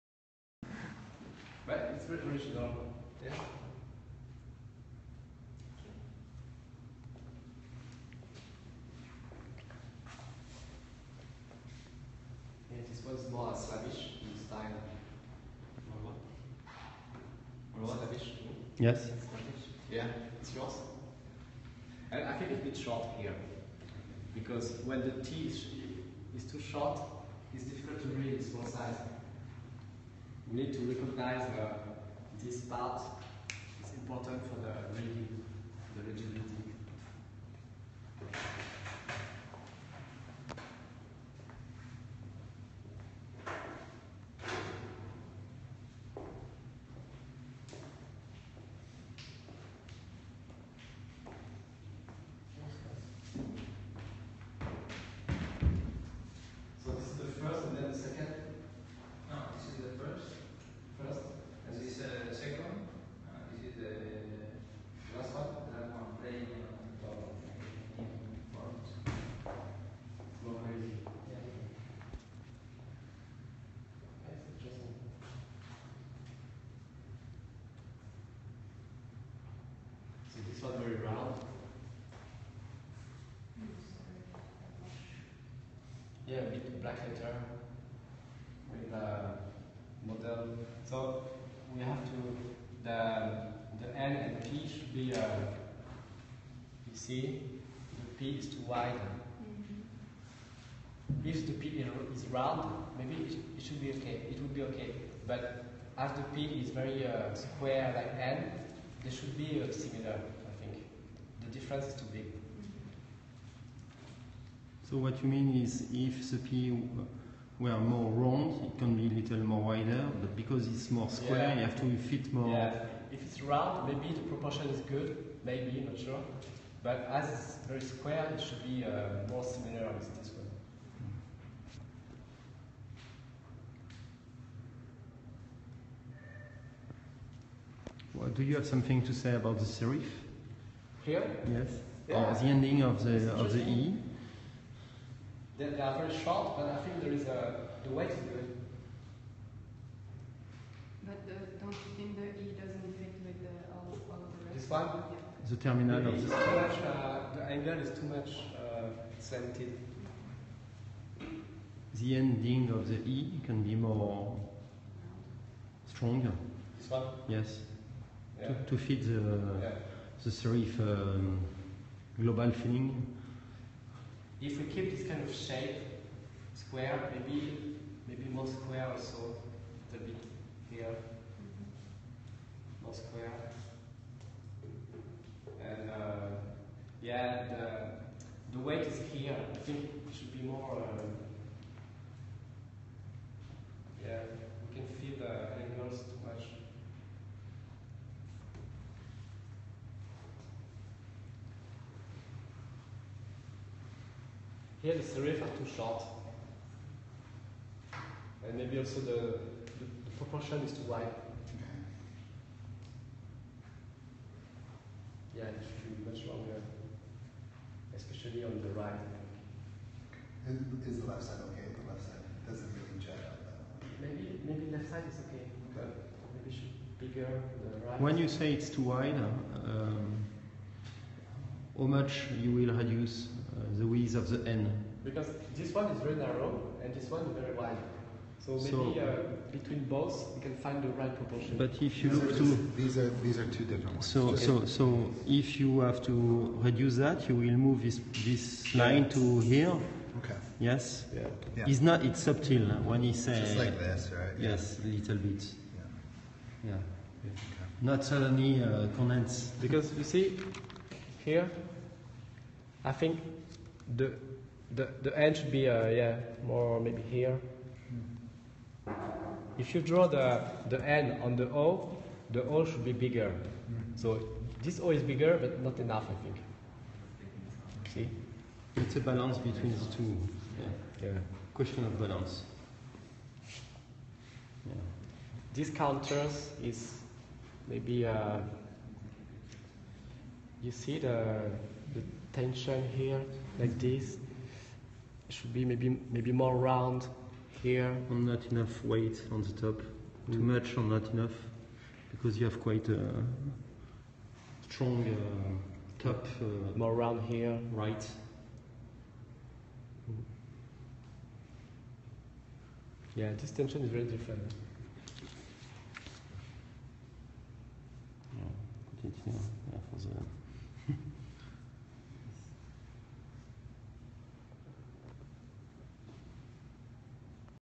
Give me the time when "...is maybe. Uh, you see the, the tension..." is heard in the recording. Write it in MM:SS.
04:46.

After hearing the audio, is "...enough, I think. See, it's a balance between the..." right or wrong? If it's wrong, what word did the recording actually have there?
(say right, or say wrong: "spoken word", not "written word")
right.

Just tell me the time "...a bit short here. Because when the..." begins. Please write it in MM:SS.
00:22.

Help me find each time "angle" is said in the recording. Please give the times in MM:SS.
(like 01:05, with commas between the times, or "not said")
02:37.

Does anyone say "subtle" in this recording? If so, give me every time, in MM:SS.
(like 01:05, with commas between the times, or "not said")
04:12.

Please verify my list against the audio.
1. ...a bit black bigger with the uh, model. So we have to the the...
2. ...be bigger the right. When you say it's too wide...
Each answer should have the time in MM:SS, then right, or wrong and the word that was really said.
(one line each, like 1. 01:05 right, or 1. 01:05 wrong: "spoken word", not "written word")
1. 01:26 wrong: "letter", not "bigger"
2. 03:46 right.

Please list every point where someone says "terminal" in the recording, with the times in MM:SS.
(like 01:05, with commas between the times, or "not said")
02:35.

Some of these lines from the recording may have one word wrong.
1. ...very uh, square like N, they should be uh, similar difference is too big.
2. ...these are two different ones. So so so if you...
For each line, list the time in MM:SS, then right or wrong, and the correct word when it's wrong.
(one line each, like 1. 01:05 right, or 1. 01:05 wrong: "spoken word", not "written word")
1. 01:46 right
2. 04:03 right.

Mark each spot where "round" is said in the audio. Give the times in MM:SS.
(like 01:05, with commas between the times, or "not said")
01:20, 01:42, 01:58, 02:03, 04:56, 05:06.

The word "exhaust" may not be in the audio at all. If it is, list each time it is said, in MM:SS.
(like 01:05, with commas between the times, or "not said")
not said.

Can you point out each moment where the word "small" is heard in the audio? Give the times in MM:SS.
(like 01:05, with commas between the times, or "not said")
00:28.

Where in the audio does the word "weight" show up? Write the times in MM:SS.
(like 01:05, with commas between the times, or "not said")
02:27, 03:08, 04:58.